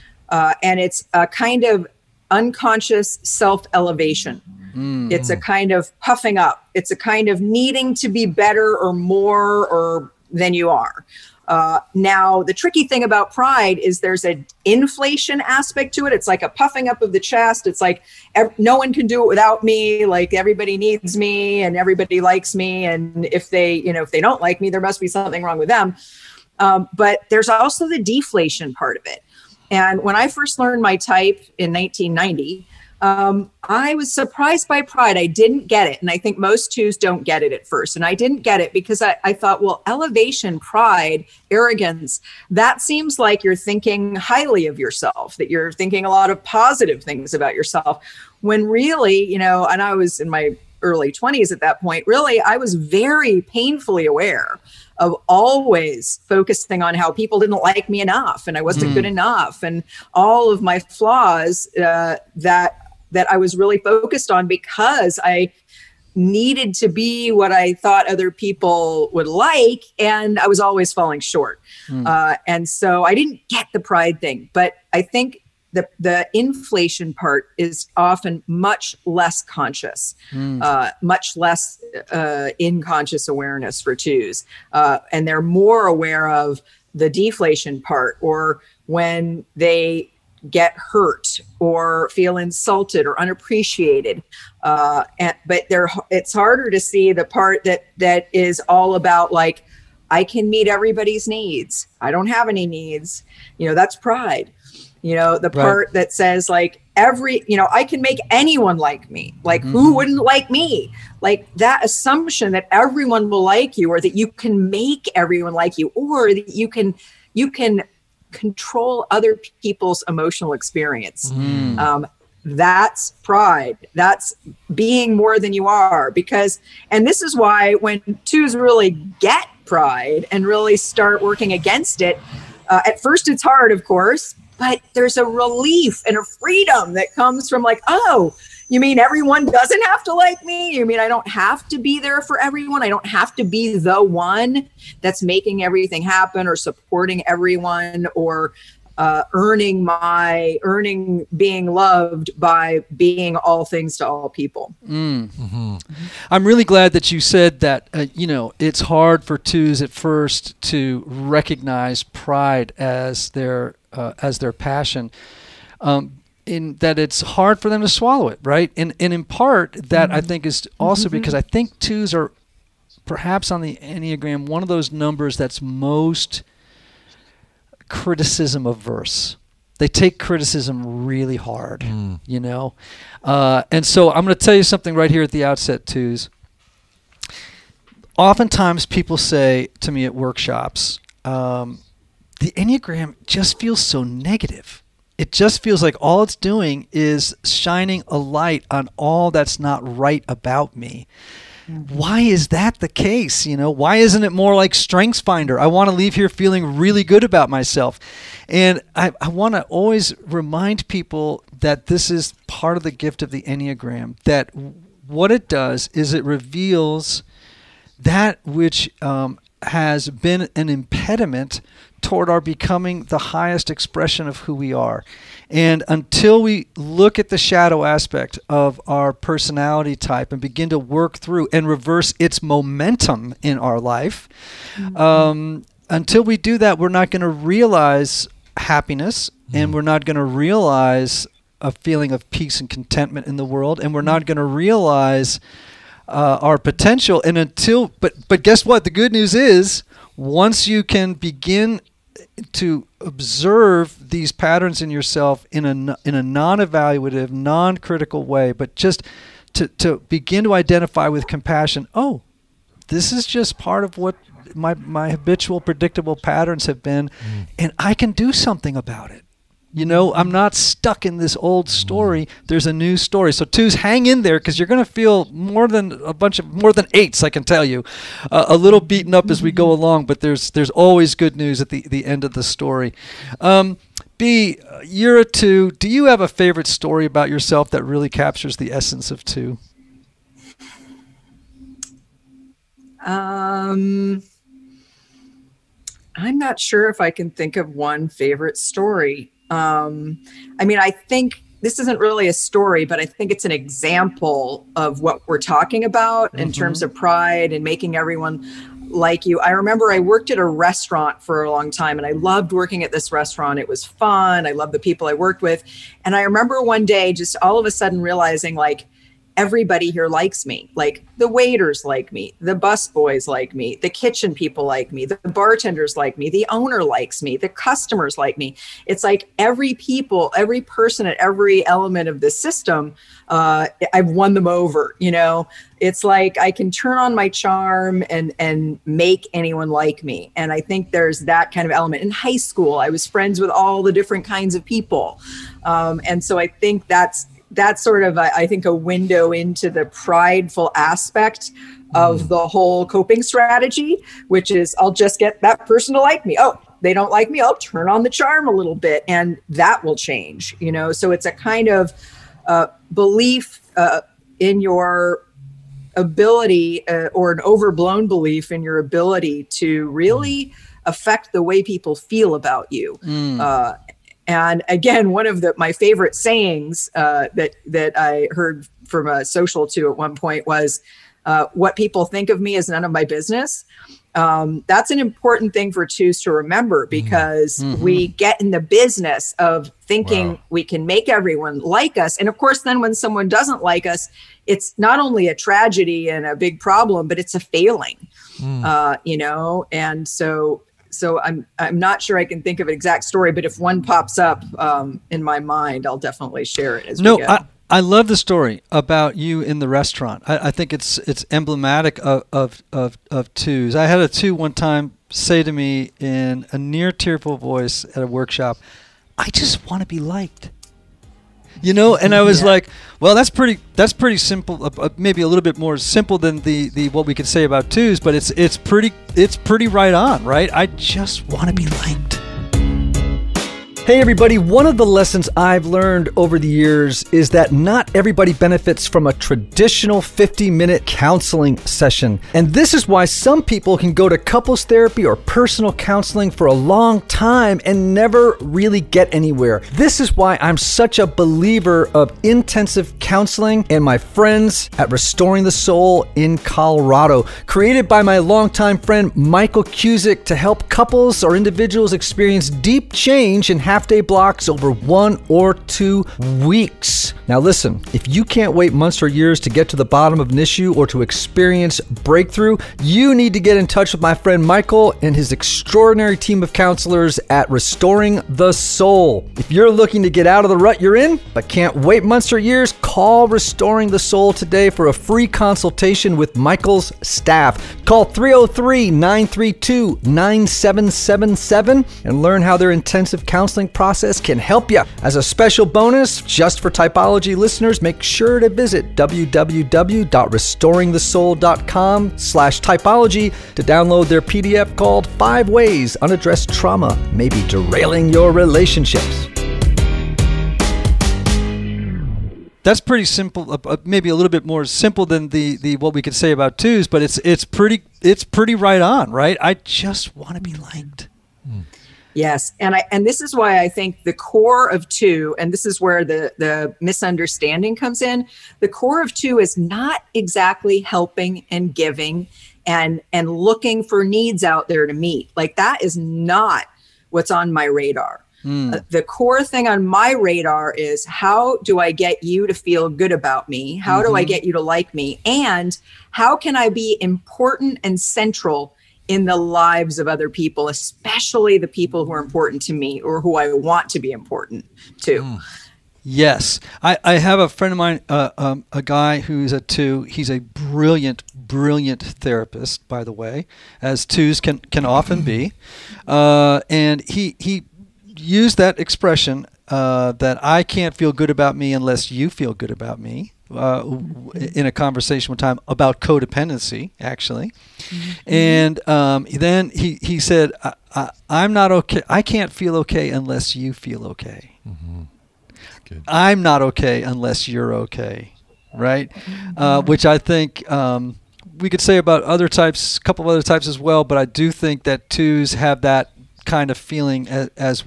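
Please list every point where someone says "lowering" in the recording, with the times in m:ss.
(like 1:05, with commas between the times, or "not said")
not said.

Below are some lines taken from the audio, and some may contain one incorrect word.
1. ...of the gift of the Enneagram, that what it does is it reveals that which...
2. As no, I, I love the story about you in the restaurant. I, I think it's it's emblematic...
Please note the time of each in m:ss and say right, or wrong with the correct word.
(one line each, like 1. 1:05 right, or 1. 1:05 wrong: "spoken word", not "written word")
1. 3:32 right
2. 6:46 right.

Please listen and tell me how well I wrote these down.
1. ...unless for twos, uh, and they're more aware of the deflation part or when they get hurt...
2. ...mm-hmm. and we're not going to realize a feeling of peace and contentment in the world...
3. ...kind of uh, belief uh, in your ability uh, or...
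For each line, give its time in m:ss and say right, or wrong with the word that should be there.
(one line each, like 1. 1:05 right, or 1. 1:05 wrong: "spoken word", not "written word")
1. 1:23 wrong: "awareness", not "unless"
2. 3:59 right
3. 6:01 right.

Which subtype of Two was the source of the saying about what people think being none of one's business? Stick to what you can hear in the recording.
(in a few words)
social two.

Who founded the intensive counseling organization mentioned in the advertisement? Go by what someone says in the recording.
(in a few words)
Michael Cusick.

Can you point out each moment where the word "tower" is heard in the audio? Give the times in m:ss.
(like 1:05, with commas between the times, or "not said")
not said.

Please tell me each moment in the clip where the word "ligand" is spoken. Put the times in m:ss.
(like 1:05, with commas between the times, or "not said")
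not said.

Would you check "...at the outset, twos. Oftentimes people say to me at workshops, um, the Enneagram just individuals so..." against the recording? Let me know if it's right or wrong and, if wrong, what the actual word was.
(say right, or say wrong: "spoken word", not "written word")
wrong: "feels", not "individuals".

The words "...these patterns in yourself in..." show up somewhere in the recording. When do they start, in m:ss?
4:14.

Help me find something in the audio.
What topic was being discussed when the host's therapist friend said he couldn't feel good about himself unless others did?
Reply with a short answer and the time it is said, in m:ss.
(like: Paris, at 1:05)
codependency, at 9:35.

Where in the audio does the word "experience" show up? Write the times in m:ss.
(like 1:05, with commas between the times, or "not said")
2:00, 7:41, 7:51.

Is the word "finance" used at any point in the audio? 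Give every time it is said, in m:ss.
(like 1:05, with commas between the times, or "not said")
not said.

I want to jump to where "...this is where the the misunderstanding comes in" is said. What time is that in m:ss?
8:45.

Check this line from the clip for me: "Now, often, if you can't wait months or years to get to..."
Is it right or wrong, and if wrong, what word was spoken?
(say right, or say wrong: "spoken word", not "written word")
wrong: "listen", not "often".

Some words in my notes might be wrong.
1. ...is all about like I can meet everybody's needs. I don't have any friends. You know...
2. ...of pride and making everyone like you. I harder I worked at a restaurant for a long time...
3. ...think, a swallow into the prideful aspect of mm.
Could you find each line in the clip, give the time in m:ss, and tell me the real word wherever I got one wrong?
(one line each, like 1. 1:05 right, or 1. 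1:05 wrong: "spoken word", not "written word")
1. 1:38 wrong: "needs", not "friends"
2. 5:06 wrong: "remember", not "harder"
3. 5:48 wrong: "window", not "swallow".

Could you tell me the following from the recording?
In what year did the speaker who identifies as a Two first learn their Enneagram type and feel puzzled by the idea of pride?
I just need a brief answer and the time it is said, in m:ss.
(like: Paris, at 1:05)
1990, at 0:31.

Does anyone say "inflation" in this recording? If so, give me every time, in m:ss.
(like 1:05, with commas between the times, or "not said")
0:14, 1:16.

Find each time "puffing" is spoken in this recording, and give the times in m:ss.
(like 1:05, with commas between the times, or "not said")
0:05, 0:16.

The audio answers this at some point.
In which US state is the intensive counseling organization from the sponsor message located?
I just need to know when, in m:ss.
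7:36.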